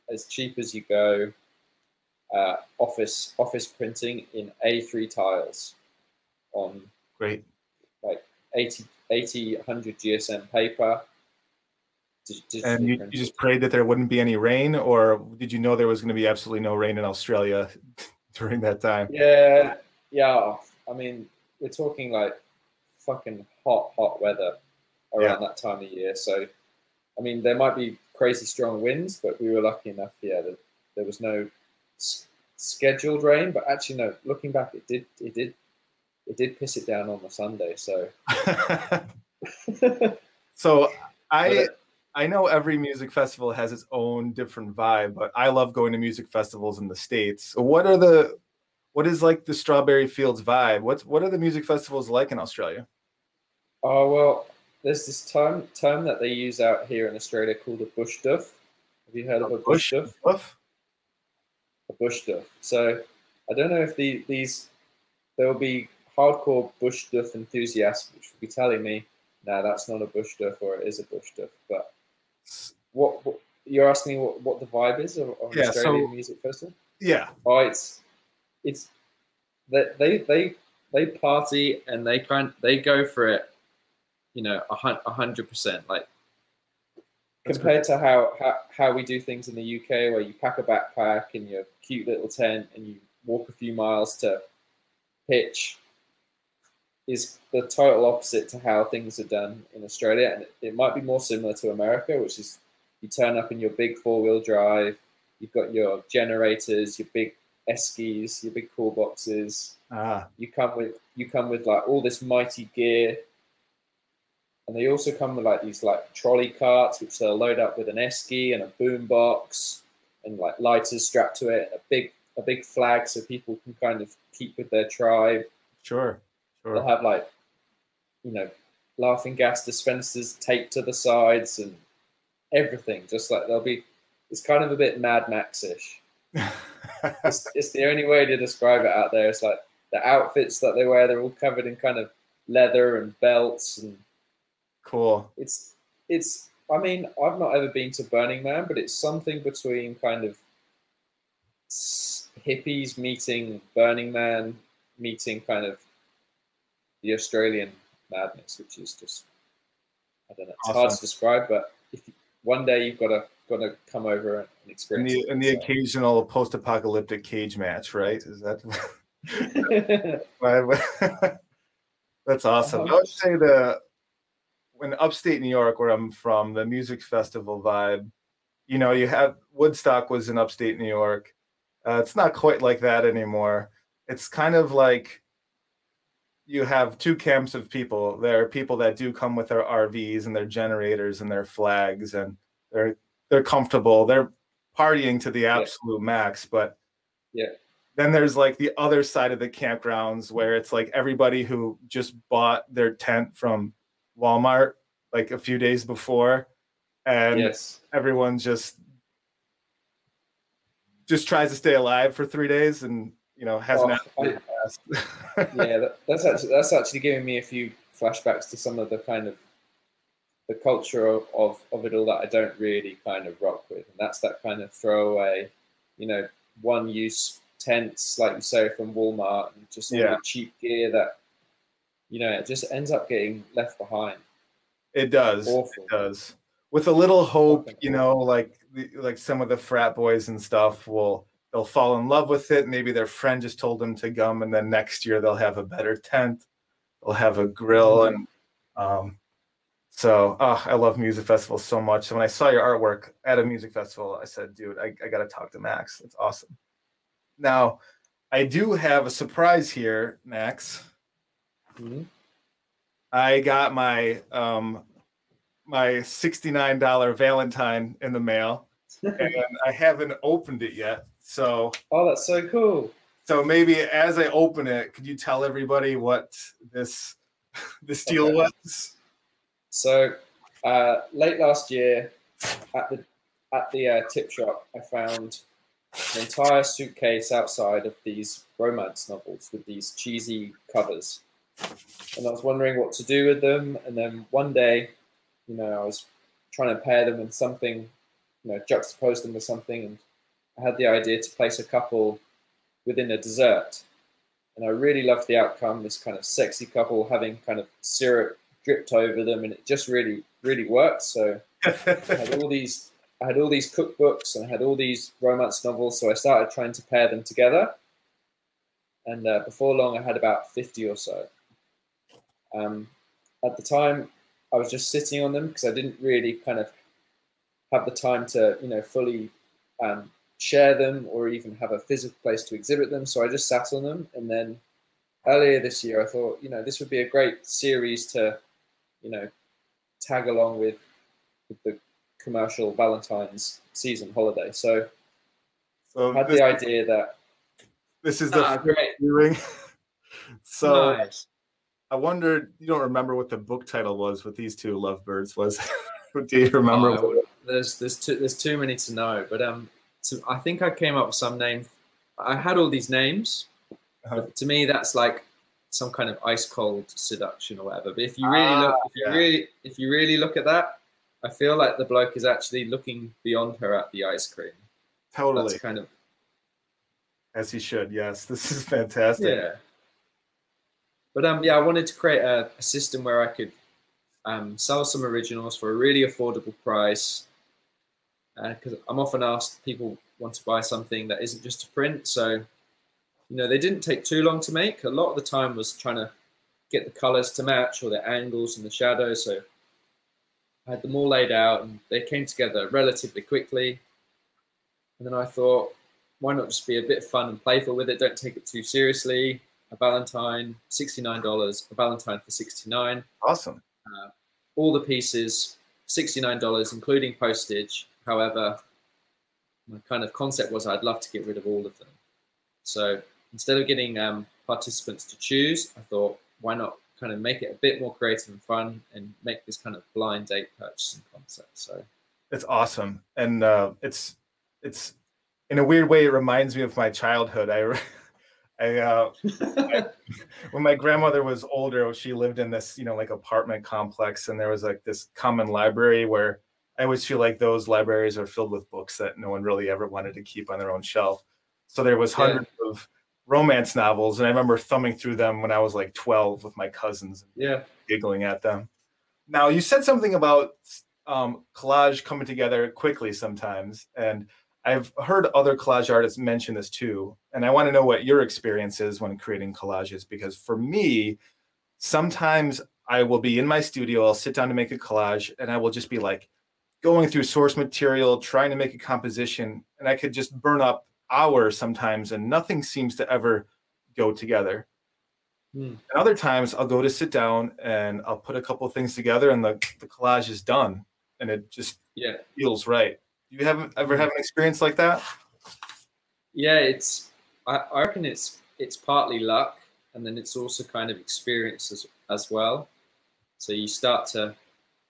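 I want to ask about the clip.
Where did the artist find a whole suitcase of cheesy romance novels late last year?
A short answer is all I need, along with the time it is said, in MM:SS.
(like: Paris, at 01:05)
tip shop, at 04:44.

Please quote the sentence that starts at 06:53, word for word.
Uh, all the pieces, $69, including postage.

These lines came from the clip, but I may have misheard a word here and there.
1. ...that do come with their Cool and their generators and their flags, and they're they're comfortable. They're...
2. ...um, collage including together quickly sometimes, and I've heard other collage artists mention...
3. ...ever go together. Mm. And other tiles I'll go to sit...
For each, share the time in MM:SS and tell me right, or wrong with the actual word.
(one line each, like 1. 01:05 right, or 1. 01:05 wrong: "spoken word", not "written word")
1. 03:08 wrong: "RVs", not "Cool"
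2. 07:41 wrong: "coming", not "including"
3. 08:03 wrong: "times", not "tiles".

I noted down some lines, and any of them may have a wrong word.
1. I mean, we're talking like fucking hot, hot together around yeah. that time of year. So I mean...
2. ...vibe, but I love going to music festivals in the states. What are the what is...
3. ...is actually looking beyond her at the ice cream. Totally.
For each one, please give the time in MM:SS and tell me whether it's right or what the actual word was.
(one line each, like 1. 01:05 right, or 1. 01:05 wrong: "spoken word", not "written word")
1. 00:20 wrong: "weather", not "together"
2. 00:44 right
3. 06:12 right.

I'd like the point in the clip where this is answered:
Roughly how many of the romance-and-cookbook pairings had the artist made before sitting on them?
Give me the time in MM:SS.
05:20.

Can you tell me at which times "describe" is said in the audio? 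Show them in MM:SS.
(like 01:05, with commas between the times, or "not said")
02:18, 02:40.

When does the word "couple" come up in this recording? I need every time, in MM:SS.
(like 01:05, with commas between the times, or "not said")
05:01, 05:06, 08:08.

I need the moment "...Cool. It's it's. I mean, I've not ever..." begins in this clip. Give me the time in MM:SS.
02:24.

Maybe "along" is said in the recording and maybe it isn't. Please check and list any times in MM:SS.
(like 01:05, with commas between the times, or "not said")
05:40.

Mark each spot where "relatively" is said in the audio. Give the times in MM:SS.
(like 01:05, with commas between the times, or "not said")
06:42.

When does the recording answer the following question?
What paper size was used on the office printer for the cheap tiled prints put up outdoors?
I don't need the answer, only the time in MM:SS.
00:04.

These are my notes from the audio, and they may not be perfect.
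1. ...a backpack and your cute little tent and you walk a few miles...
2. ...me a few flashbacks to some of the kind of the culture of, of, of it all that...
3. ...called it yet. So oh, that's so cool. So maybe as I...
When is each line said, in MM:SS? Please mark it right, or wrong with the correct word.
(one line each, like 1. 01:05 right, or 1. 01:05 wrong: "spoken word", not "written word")
1. 01:30 right
2. 03:37 right
3. 04:30 wrong: "opened", not "called".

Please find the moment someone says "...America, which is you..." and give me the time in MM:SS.
01:41.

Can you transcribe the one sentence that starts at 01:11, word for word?
But what, what you're asking what, what the vibe is of, of yeah, Australian so, music festival?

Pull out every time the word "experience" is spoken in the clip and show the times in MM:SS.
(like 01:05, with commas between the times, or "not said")
02:44, 07:48, 08:14, 08:20.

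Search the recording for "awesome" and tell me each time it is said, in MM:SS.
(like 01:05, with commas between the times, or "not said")
02:40, 02:52, 04:16, 06:53, 07:12.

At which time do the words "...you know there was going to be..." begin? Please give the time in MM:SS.
00:15.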